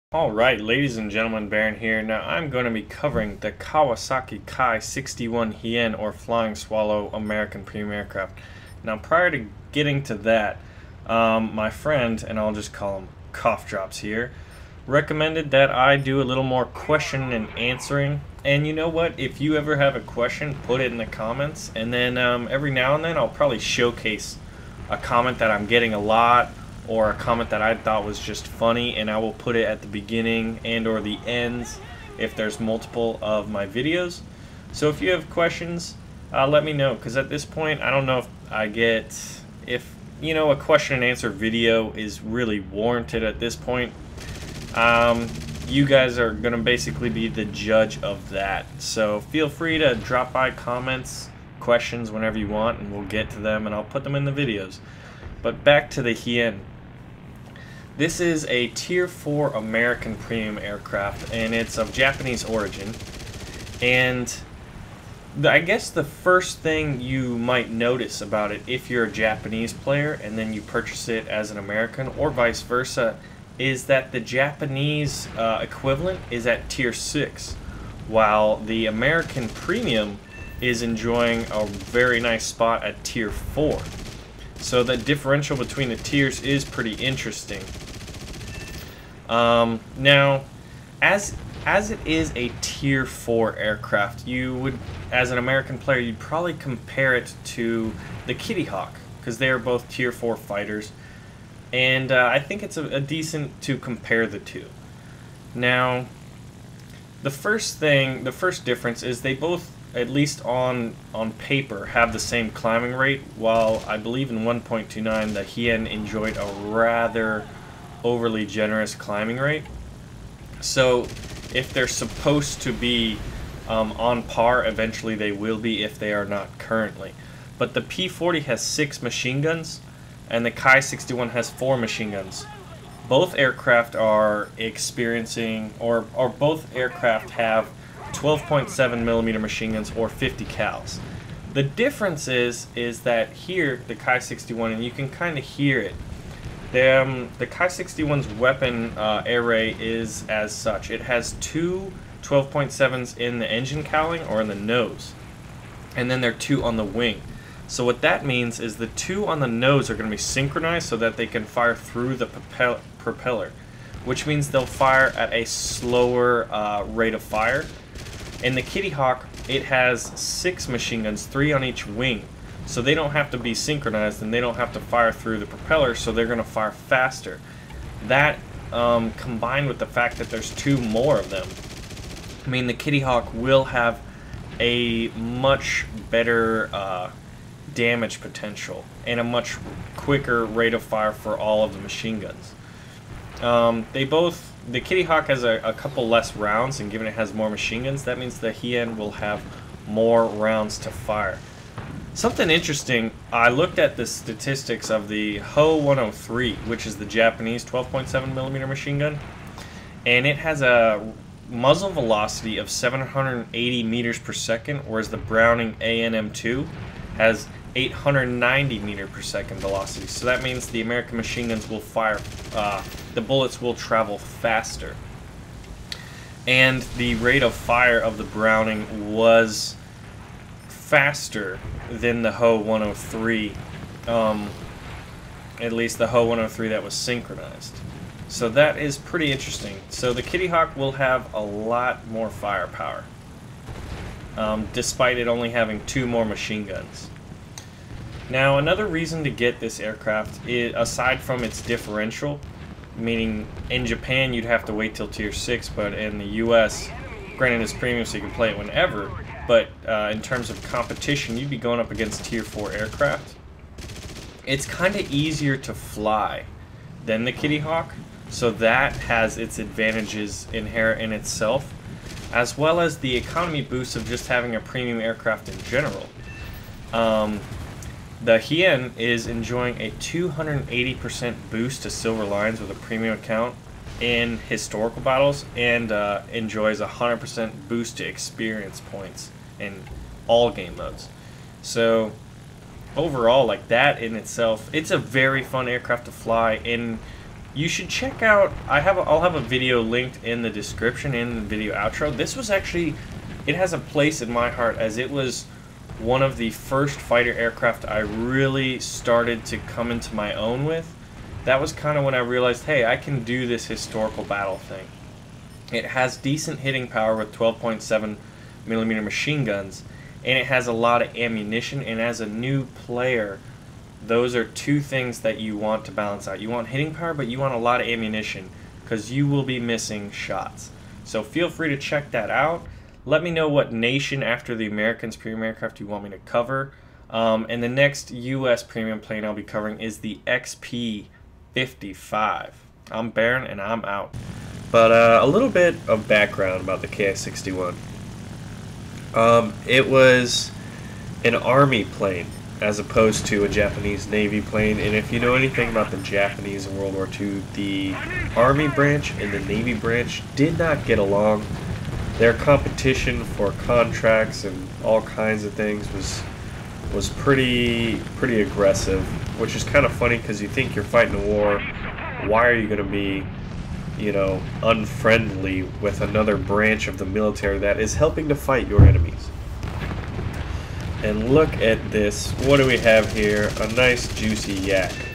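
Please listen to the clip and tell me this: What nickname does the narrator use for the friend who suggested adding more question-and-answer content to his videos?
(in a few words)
Cough Drops.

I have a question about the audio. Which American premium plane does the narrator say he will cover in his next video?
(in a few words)
XP-55.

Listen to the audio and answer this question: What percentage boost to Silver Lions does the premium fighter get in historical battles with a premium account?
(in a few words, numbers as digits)
280%.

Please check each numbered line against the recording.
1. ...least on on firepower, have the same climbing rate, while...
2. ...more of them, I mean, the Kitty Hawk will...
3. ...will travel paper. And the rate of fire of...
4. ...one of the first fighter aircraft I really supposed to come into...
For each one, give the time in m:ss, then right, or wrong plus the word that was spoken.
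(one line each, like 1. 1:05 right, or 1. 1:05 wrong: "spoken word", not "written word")
1. 1:50 wrong: "paper", not "firepower"
2. 3:00 right
3. 3:43 wrong: "faster", not "paper"
4. 5:05 wrong: "started", not "supposed".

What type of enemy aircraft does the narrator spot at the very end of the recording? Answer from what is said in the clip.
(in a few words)
Yak.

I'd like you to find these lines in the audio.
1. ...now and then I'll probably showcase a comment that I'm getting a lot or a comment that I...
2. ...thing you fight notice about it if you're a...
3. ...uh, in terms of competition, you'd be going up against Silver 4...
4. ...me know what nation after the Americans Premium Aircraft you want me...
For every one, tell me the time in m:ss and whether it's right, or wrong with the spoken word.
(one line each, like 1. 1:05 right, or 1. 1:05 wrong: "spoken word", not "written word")
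1. 0:22 right
2. 1:06 wrong: "might", not "fight"
3. 4:19 wrong: "Tier", not "Silver"
4. 5:33 right.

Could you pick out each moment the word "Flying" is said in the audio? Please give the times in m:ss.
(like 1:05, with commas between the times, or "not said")
0:06.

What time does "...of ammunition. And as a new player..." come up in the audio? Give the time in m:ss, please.
5:21.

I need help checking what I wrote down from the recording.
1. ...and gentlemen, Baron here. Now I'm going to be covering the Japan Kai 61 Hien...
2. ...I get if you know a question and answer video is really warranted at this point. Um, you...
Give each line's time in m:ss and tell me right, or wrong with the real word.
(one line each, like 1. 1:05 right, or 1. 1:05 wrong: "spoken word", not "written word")
1. 0:00 wrong: "Kawasaki", not "Japan"
2. 0:38 right.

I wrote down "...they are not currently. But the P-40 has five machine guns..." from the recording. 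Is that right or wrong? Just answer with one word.
wrong.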